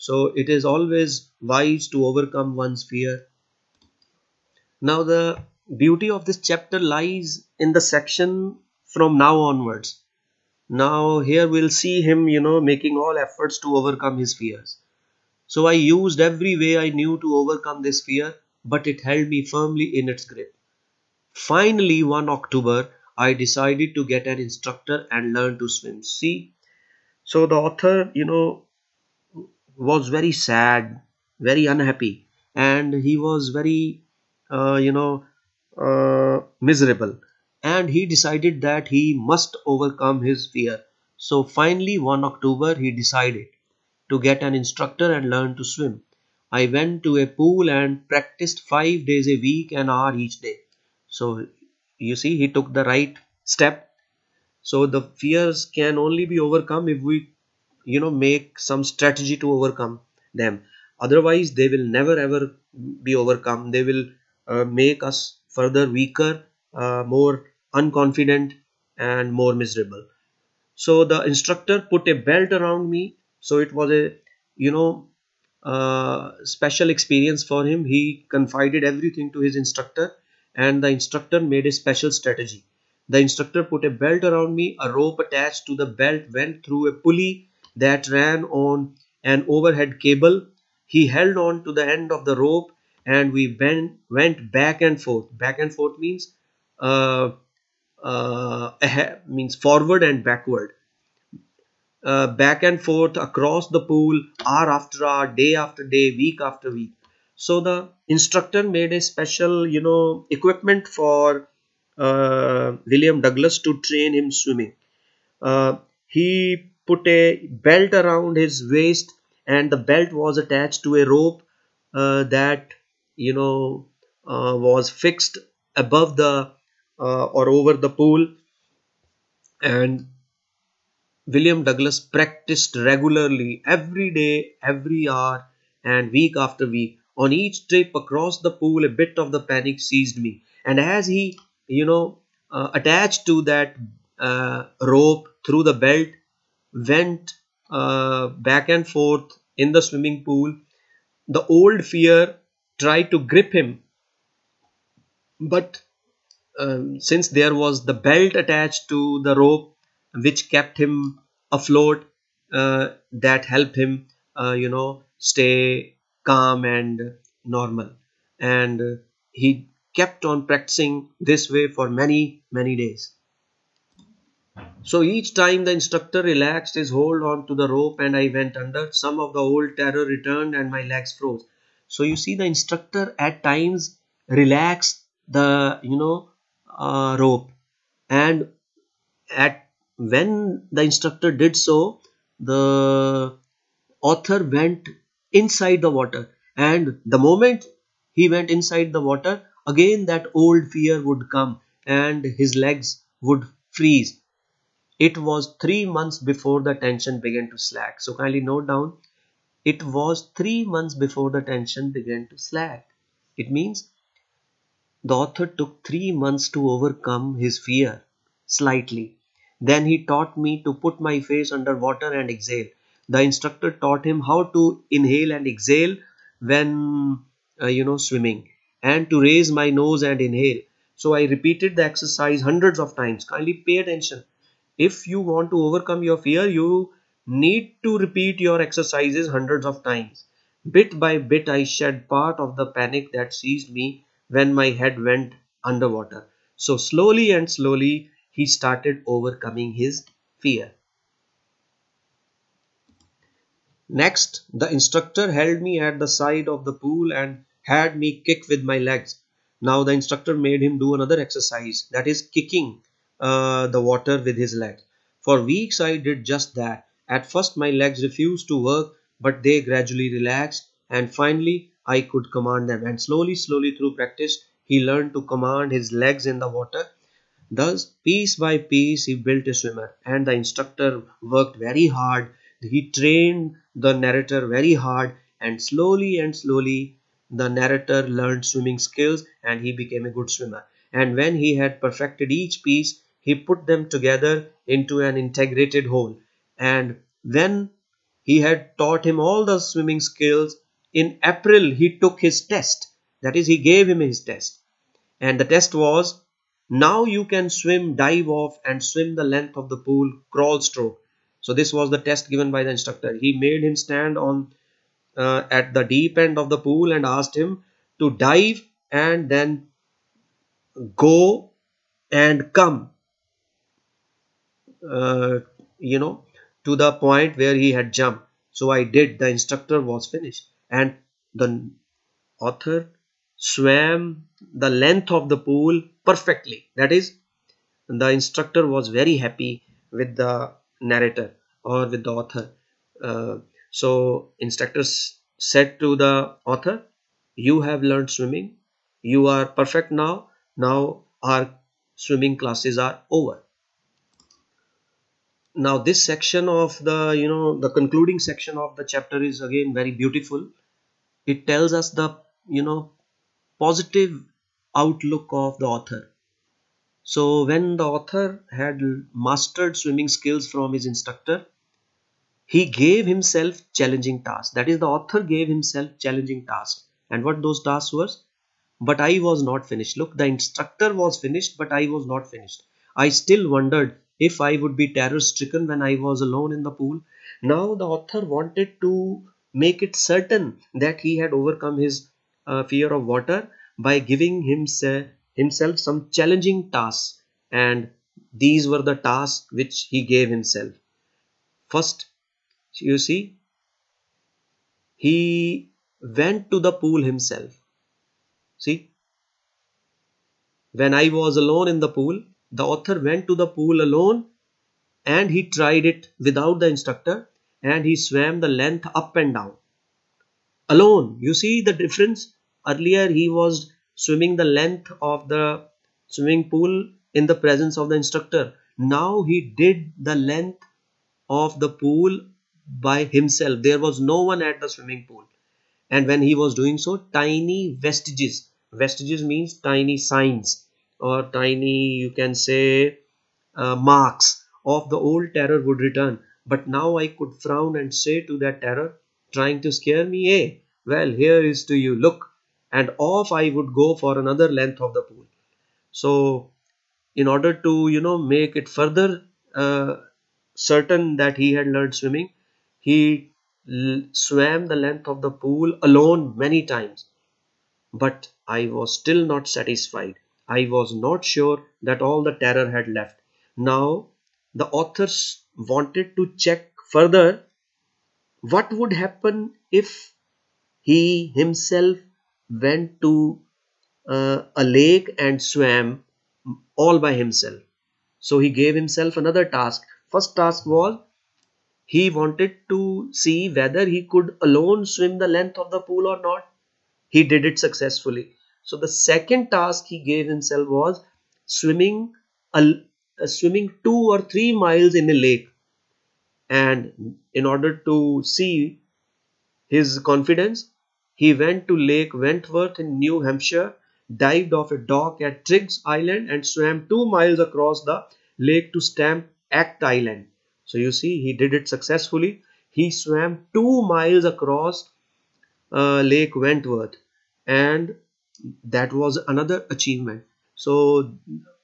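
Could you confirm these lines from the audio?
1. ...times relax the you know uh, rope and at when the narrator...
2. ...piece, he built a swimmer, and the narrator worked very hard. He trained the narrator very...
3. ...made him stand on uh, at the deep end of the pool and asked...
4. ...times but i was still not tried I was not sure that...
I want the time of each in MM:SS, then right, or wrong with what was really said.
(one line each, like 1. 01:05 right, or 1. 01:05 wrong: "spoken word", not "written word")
1. 03:03 wrong: "instructor", not "narrator"
2. 04:38 wrong: "instructor", not "narrator"
3. 05:13 right
4. 07:46 wrong: "satisfied", not "tried".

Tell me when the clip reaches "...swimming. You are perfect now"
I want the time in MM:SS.
05:48.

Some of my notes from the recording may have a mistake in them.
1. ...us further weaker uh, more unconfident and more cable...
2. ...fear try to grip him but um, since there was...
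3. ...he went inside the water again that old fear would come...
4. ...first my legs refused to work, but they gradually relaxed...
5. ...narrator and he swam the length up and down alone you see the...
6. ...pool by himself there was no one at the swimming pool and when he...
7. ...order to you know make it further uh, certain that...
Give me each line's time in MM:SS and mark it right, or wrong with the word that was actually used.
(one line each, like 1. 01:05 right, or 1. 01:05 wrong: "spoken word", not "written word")
1. 01:05 wrong: "miserable", not "cable"
2. 02:31 right
3. 03:18 right
4. 04:27 right
5. 06:56 wrong: "instructor", not "narrator"
6. 07:11 right
7. 07:37 right.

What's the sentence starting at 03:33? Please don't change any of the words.
It means the author took three months to overcome his fear slightly.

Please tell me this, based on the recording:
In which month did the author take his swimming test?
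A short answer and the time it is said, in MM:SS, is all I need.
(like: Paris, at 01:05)
April, at 05:01.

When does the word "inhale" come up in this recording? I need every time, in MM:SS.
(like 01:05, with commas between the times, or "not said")
03:44, 03:50.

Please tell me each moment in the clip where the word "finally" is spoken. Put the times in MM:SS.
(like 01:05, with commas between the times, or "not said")
00:21, 00:41, 04:31.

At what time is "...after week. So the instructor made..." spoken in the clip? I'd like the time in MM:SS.
01:46.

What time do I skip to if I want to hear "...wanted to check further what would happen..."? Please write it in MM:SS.
07:55.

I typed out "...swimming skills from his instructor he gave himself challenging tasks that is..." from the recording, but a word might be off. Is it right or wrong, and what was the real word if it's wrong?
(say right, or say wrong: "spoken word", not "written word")
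right.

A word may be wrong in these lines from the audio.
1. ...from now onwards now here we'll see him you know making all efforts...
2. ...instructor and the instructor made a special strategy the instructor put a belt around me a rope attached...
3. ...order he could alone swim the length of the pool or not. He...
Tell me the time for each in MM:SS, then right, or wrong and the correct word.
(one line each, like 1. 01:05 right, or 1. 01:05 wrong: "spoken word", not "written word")
1. 00:08 right
2. 01:19 right
3. 08:13 wrong: "whether", not "order".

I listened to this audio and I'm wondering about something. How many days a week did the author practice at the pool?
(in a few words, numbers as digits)
5.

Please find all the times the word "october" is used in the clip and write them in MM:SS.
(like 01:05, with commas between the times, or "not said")
00:22, 00:42.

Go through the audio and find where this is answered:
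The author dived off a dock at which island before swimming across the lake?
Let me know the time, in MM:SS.
08:35.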